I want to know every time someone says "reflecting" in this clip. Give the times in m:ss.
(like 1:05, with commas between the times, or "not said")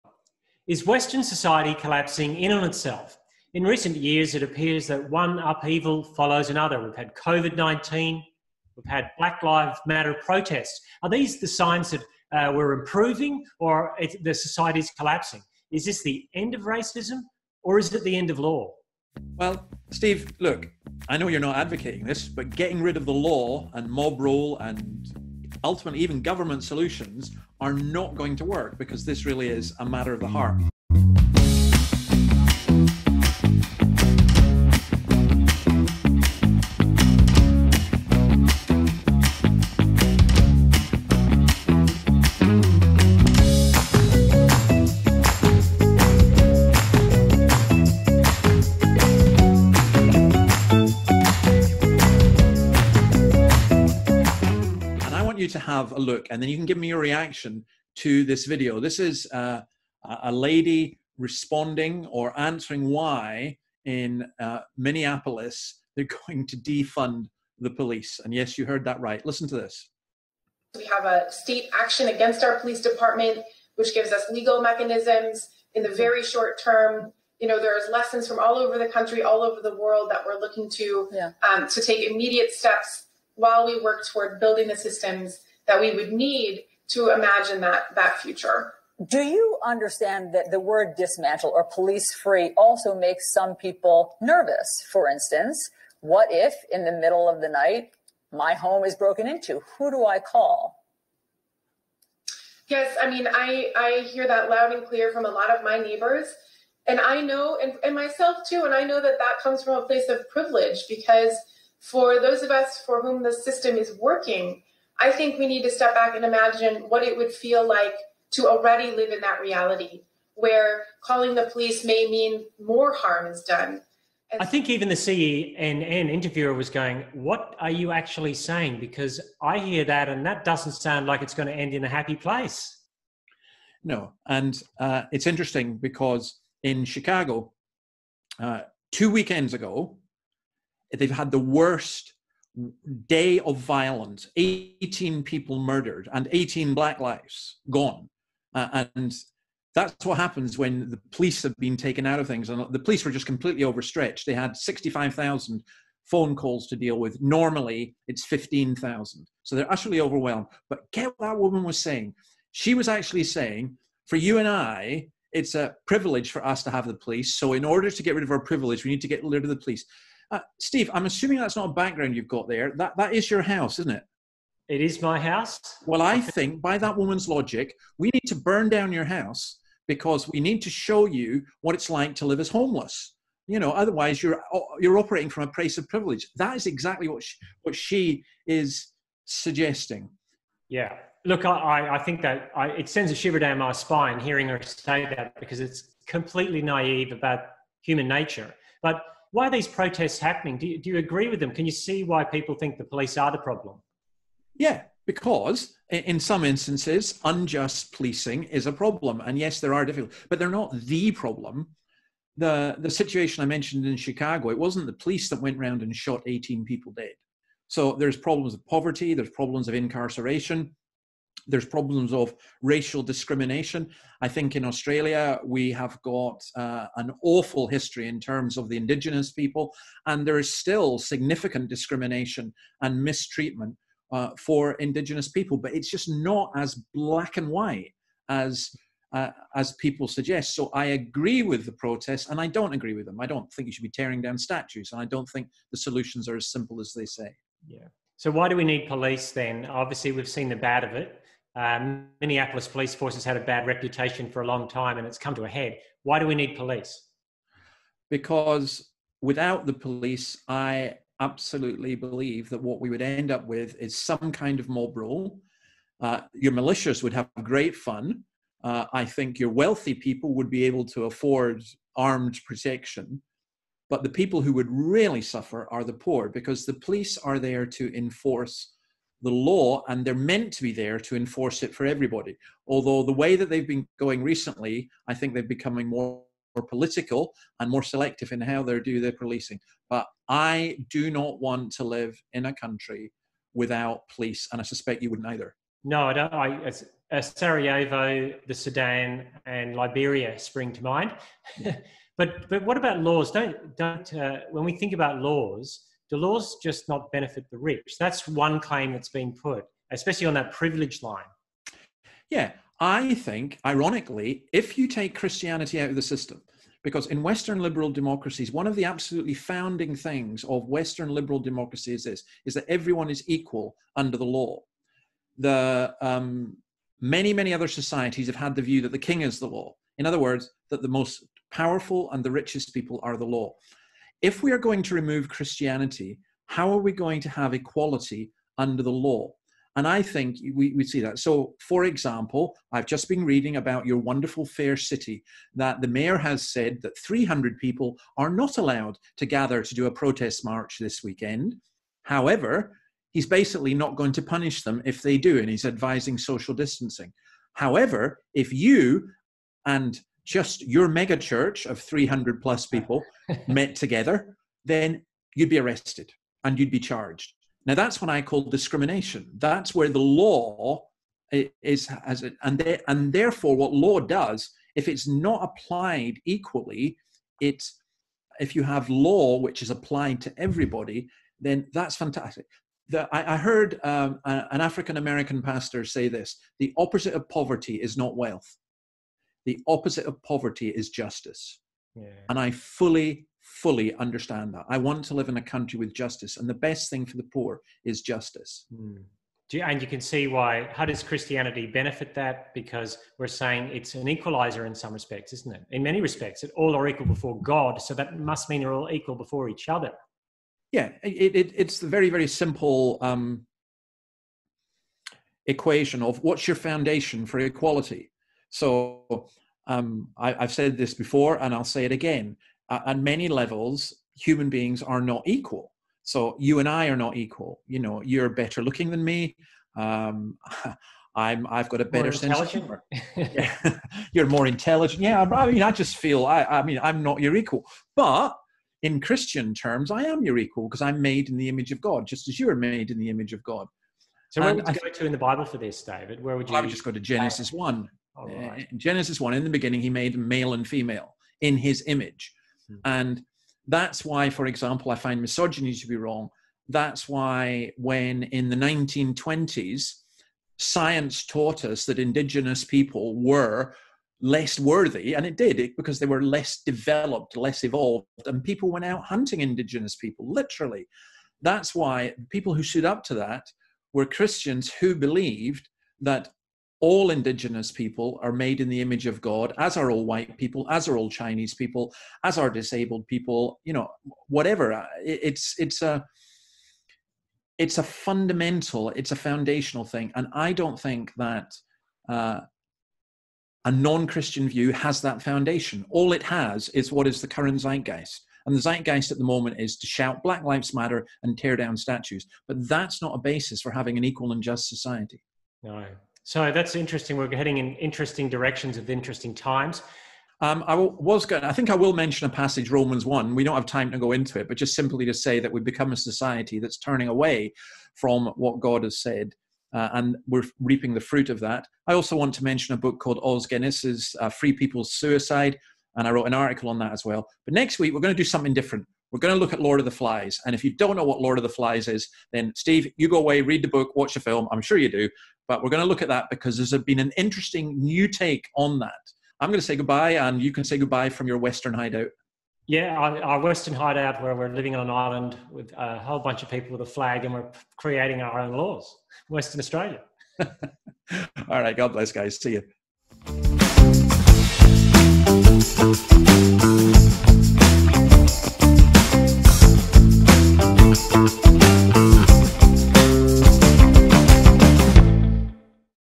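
not said.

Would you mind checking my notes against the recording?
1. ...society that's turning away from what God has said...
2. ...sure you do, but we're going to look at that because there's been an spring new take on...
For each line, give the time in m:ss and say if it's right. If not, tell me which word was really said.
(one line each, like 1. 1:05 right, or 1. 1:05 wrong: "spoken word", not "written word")
1. 8:35 right
2. 8:54 wrong: "interesting", not "spring".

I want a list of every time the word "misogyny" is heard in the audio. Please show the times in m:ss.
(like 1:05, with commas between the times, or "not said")
7:35.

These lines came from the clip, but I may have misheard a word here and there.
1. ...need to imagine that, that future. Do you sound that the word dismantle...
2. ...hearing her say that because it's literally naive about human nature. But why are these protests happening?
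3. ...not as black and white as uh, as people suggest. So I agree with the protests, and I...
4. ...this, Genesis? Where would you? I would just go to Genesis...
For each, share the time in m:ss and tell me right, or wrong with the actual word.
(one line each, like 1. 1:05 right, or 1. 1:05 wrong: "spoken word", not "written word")
1. 1:26 wrong: "understand", not "sound"
2. 3:14 wrong: "completely", not "literally"
3. 3:56 right
4. 7:25 wrong: "David", not "Genesis".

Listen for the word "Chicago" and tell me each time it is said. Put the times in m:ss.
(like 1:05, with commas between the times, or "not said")
2:16, 3:33.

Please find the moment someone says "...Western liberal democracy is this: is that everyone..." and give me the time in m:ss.
5:20.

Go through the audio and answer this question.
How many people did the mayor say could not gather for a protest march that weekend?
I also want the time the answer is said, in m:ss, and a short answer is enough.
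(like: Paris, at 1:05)
300, at 5:46.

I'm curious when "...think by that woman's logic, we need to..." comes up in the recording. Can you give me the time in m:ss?
2:56.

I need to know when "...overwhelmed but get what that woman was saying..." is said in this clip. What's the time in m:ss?
2:40.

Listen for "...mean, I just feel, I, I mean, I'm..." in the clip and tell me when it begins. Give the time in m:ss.
7:15.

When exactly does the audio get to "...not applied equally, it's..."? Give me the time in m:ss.
6:15.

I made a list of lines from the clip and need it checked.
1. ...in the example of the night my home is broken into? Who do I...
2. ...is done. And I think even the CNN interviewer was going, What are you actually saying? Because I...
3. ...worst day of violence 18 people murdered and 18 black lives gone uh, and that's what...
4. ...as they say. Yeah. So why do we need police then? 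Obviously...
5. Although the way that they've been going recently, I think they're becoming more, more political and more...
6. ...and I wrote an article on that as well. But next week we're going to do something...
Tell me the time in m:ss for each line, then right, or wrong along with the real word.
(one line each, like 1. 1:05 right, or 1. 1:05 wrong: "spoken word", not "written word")
1. 1:36 wrong: "middle", not "example"
2. 2:03 right
3. 2:21 right
4. 4:06 right
5. 4:42 right
6. 8:45 right.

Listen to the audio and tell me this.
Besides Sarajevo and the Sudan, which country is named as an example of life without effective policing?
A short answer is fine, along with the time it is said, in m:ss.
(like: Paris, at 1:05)
Liberia, at 4:59.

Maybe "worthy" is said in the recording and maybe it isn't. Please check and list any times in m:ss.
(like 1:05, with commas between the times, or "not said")
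7:44.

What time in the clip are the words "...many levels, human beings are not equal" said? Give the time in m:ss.
7:02.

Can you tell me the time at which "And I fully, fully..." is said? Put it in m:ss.
6:32.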